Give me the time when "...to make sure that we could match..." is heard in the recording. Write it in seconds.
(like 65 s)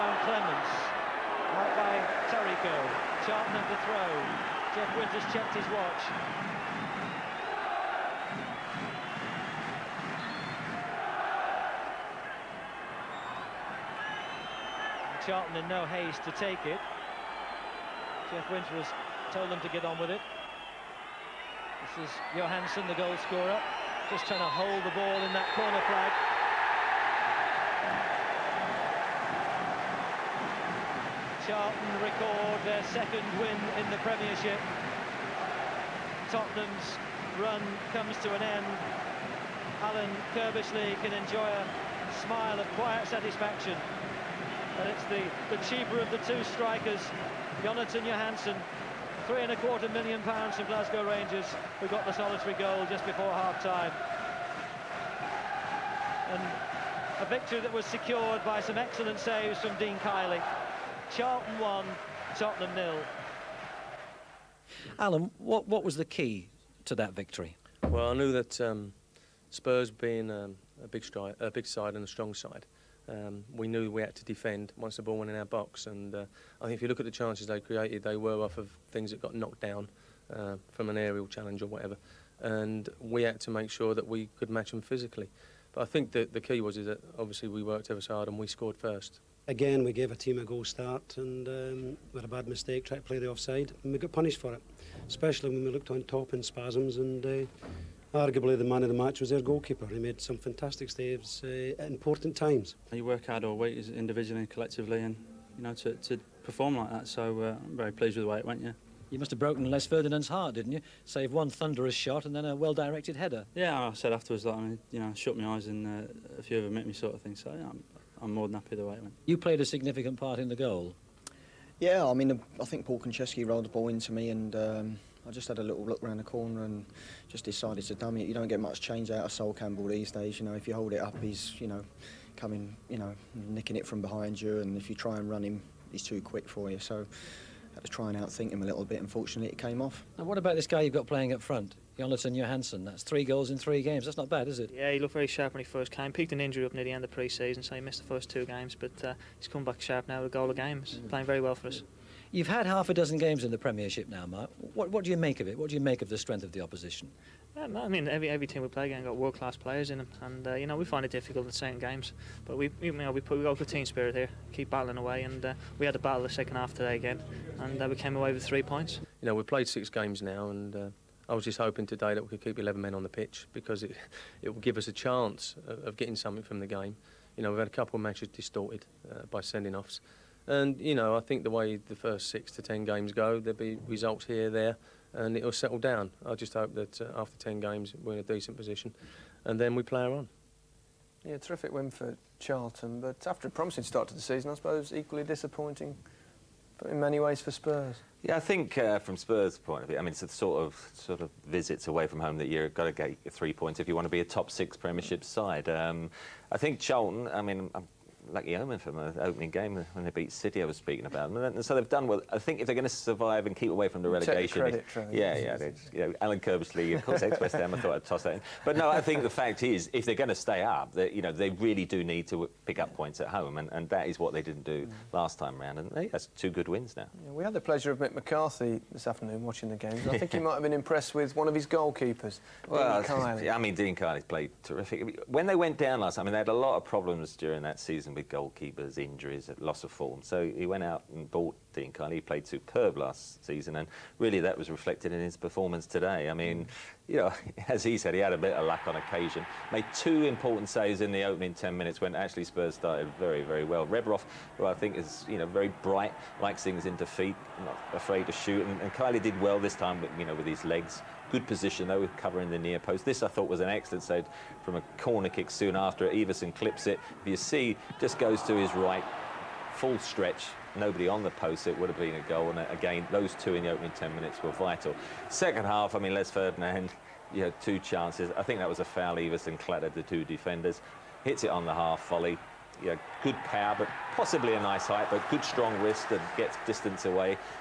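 83 s.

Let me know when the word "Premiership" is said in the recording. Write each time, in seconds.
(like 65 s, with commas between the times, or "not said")
33 s, 153 s, 204 s.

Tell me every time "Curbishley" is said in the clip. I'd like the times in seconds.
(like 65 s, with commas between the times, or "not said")
40 s, 216 s.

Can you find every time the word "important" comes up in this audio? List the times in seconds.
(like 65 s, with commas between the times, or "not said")
101 s, 250 s.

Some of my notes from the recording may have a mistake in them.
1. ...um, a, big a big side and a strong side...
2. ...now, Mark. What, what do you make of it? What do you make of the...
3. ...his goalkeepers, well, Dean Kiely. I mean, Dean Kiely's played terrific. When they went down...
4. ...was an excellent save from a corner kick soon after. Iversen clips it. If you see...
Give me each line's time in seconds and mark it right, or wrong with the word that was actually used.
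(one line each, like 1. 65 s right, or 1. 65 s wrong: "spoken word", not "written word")
1. 70 s right
2. 154 s right
3. 231 s right
4. 263 s right.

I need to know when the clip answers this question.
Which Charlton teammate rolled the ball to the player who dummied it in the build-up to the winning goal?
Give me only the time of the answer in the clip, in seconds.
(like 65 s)
122 s.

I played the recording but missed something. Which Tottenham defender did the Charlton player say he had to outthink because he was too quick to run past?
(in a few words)
Sol Campbell.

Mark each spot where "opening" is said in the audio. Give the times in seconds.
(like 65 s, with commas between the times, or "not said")
209 s, 251 s, 273 s.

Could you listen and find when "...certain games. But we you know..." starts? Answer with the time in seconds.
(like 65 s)
161 s.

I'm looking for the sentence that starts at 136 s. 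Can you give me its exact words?
So I had to try and outthink him a little bit.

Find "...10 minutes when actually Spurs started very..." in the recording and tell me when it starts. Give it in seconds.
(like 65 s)
251 s.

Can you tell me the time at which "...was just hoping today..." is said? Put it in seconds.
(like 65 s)
171 s.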